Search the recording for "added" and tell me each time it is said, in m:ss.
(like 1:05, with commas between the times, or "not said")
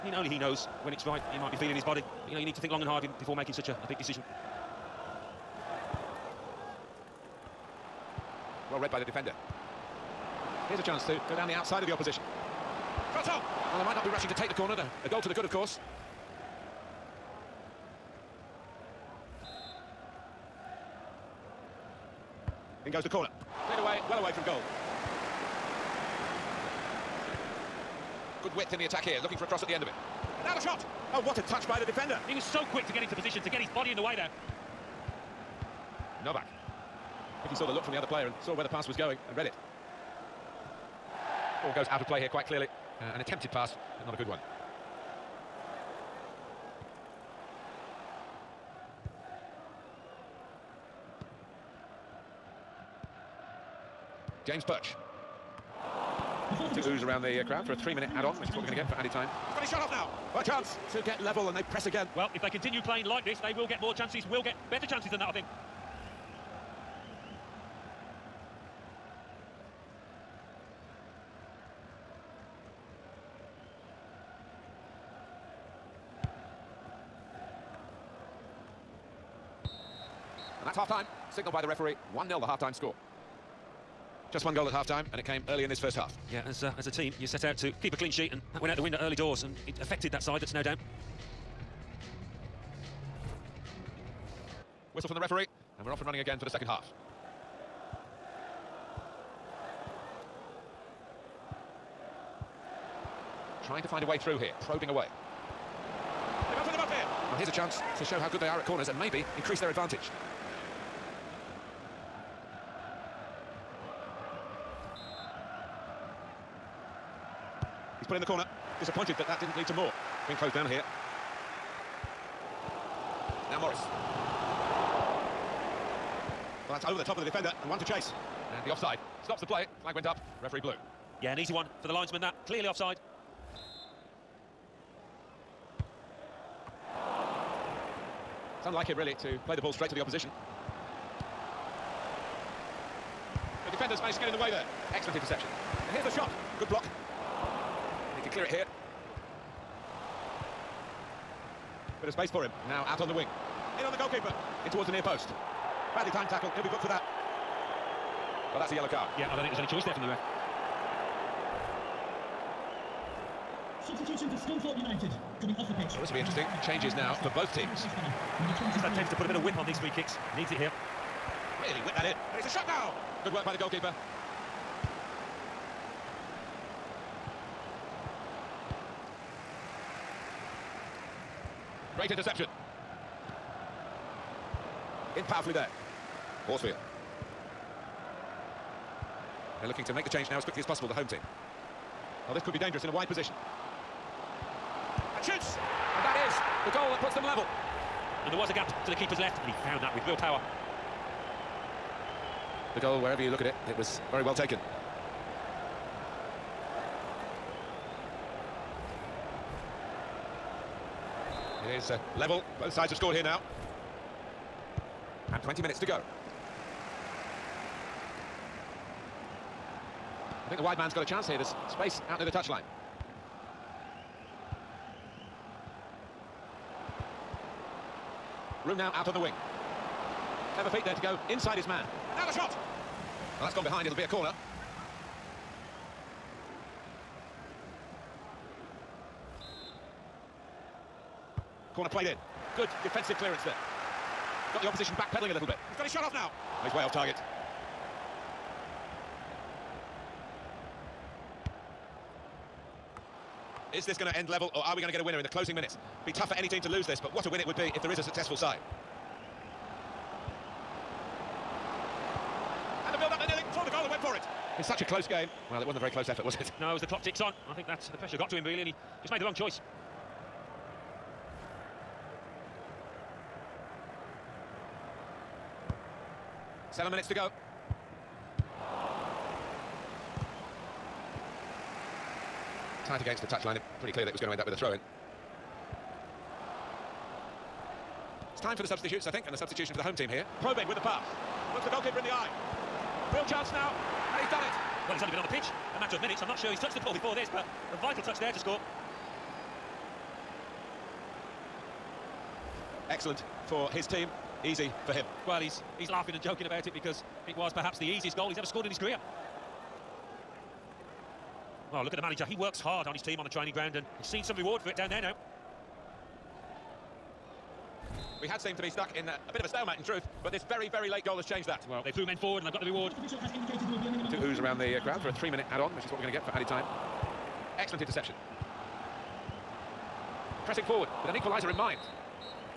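0:58, 5:26.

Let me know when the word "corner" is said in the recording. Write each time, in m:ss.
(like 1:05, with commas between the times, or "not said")
0:14, 0:23, 1:48, 1:58, 3:54, 4:01.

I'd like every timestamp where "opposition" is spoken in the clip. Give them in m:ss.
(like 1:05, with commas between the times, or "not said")
0:11, 2:19, 4:04.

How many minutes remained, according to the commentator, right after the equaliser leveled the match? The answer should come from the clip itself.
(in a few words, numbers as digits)
20.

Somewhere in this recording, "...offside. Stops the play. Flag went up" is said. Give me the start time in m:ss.
2:08.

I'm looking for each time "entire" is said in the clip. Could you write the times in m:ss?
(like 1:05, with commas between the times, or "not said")
not said.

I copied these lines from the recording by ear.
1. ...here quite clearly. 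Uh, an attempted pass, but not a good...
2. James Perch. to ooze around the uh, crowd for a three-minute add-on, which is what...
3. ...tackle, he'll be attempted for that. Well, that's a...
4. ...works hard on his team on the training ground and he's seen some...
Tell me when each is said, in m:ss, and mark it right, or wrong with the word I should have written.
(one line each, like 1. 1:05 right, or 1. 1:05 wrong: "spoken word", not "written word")
1. 0:42 right
2. 0:54 right
3. 2:36 wrong: "booked", not "attempted"
4. 5:12 right.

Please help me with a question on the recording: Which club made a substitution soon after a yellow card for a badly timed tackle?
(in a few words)
Scunthorpe United.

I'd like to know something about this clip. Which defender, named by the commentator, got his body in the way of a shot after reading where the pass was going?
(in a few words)
Novak.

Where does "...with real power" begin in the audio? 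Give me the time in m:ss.
3:19.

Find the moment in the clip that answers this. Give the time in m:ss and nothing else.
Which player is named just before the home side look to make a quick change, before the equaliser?
3:06.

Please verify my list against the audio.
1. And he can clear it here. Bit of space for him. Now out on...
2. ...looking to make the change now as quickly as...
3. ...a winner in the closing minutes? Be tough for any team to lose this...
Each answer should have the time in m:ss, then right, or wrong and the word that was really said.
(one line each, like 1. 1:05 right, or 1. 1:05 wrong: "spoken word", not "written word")
1. 2:27 right
2. 3:09 right
3. 4:14 right.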